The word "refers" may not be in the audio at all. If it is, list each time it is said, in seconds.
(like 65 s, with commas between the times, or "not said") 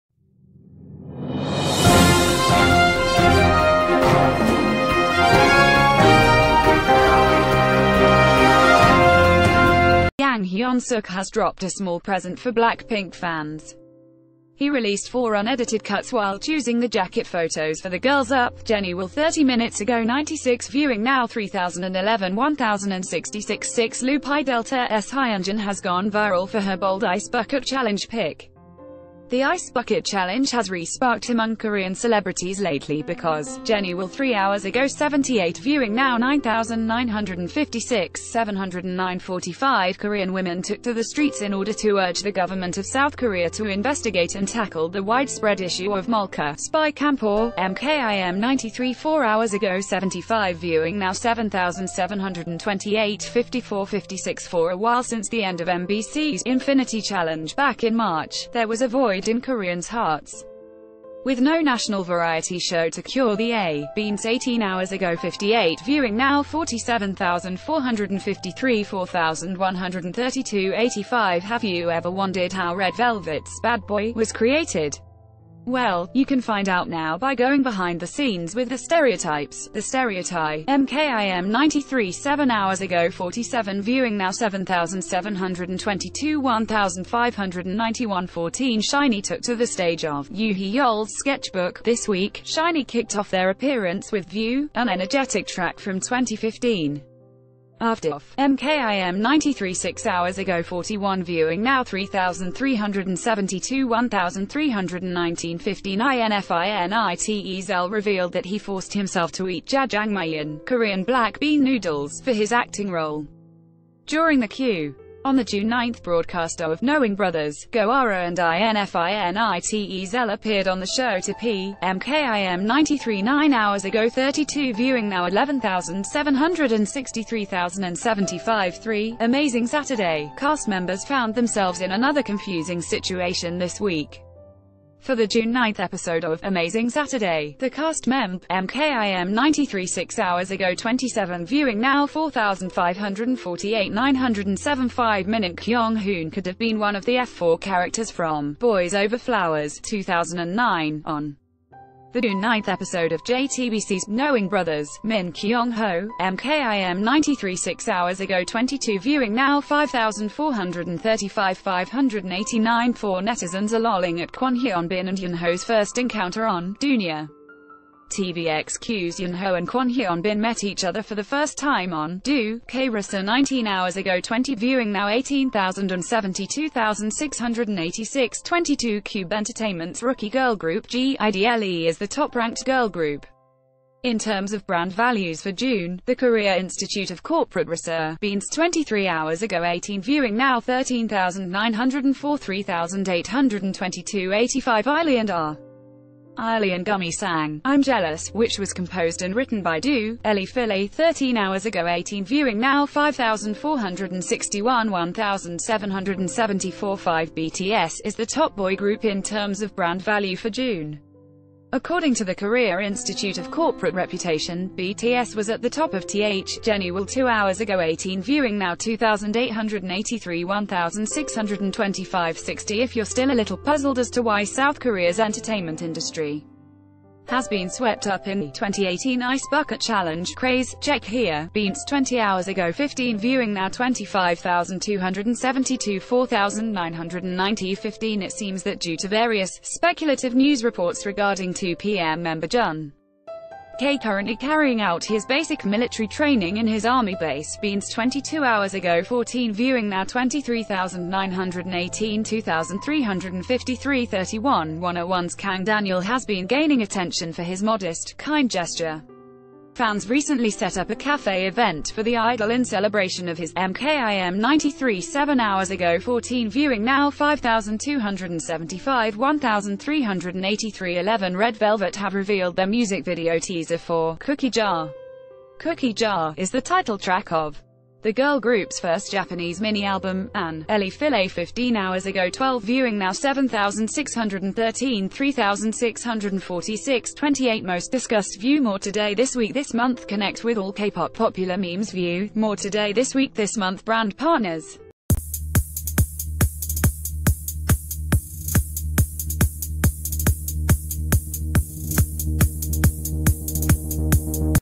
not said.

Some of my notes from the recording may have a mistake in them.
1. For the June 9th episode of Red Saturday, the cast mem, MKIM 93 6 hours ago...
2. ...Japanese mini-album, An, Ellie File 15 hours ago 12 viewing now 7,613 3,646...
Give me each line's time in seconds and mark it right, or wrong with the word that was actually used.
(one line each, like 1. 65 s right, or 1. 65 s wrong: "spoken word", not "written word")
1. 135 s wrong: "Amazing", not "Red"
2. 279 s right.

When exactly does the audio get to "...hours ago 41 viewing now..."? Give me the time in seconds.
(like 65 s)
100 s.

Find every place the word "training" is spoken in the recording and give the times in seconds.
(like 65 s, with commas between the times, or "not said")
246 s.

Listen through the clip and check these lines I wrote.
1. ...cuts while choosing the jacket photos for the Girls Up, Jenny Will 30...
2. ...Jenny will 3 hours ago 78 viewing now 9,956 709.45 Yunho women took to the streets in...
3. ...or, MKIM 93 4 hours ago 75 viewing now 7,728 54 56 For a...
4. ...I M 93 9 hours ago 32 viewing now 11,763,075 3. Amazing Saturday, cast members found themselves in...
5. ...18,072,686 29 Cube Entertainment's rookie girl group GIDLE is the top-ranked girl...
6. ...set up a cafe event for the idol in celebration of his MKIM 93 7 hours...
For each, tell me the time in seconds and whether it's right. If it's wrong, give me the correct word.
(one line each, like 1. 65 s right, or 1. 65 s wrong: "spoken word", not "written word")
1. 15 s right
2. 33 s wrong: "Korean", not "Yunho"
3. 47 s right
4. 122 s right
5. 175 s wrong: "22", not "29"
6. 260 s right.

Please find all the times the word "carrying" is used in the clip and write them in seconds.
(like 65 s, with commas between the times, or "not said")
244 s.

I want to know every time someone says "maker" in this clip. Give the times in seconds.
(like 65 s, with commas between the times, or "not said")
not said.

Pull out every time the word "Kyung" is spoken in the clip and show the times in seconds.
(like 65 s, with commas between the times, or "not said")
145 s, 155 s.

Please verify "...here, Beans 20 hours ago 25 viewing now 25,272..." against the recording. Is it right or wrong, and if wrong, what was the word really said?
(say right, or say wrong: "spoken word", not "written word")
wrong: "15", not "25".